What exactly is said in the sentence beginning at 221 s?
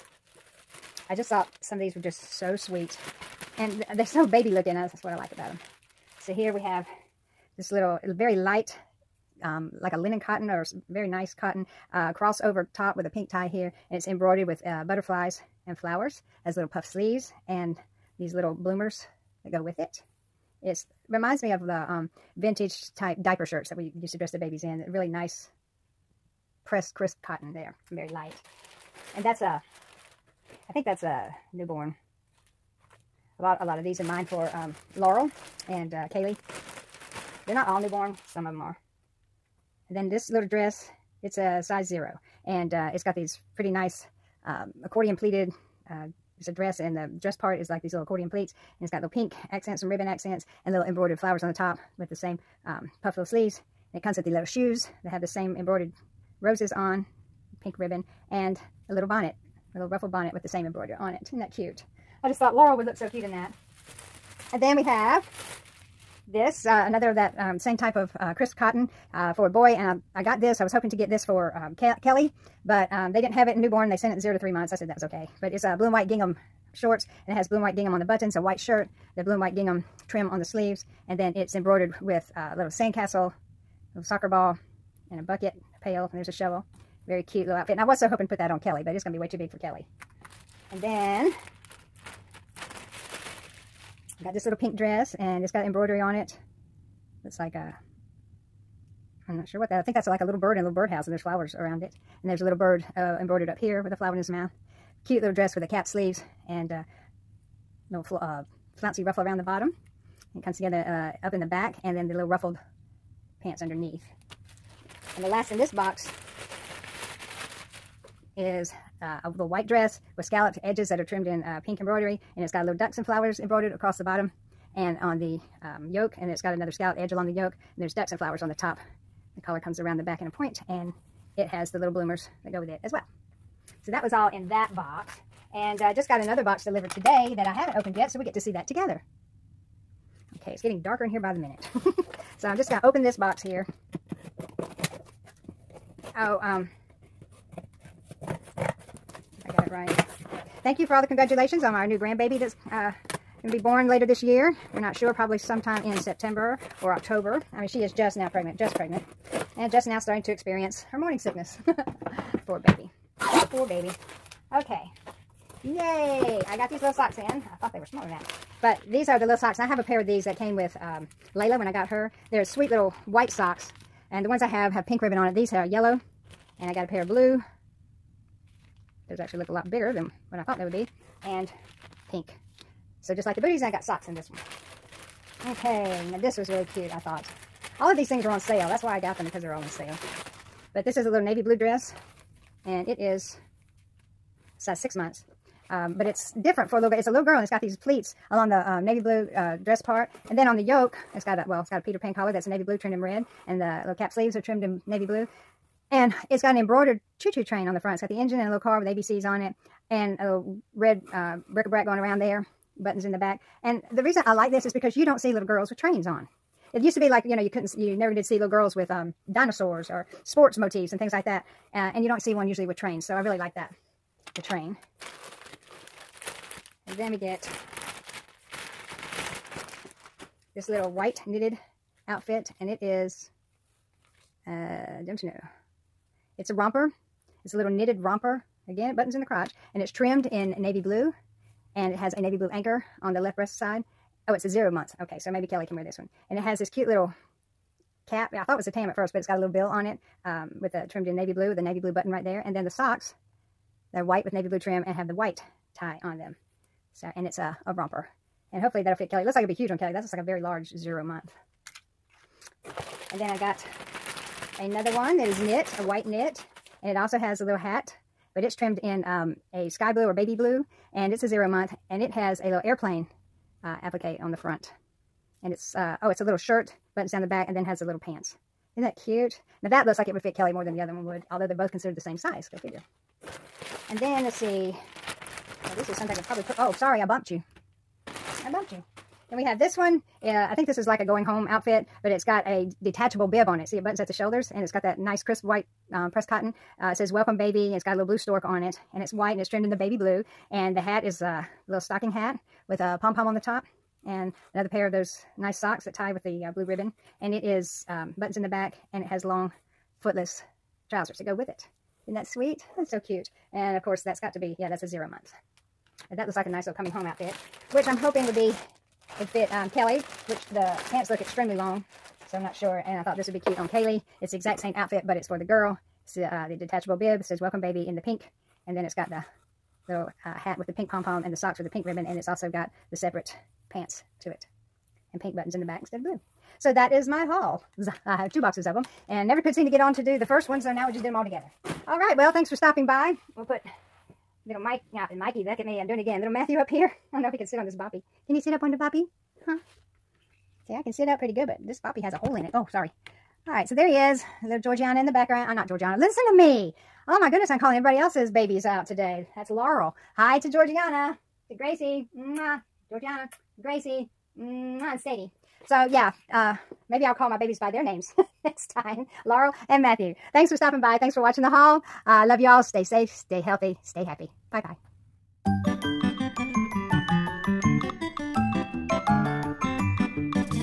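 Uh, and you don't see one usually with trains.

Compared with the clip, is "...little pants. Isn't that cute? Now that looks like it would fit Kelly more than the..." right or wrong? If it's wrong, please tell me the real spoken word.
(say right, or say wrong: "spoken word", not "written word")
right.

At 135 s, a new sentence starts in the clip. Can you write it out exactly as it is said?
And uh, just got another box delivered today that I haven't opened yet, so we get to see that together.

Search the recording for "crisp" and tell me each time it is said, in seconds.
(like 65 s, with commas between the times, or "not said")
26 s, 68 s, 295 s.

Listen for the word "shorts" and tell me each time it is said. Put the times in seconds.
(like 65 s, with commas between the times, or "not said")
76 s.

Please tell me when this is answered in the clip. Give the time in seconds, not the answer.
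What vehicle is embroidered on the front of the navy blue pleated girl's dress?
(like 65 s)
207 s.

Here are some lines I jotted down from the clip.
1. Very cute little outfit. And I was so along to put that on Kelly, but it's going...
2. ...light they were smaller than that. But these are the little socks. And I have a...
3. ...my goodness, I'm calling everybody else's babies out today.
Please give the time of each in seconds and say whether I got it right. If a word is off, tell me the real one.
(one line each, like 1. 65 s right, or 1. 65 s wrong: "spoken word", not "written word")
1. 87 s wrong: "hoping", not "along"
2. 167 s wrong: "thought", not "light"
3. 357 s right.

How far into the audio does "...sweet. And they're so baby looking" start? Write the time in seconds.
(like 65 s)
2 s.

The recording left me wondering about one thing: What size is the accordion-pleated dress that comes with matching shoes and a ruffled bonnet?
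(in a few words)
Size zero.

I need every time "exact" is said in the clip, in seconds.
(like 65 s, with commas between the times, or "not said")
324 s.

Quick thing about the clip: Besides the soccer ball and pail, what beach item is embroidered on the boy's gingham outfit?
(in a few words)
Sandcastle.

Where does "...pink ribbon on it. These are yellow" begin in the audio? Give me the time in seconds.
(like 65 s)
174 s.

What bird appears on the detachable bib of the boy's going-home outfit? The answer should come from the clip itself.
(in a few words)
Stork.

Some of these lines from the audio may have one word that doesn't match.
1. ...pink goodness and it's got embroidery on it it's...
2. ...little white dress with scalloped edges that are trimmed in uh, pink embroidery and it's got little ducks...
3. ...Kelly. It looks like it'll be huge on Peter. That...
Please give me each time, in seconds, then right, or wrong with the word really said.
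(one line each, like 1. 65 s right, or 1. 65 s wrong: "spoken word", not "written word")
1. 94 s wrong: "dress", not "goodness"
2. 119 s right
3. 259 s wrong: "Kelly", not "Peter".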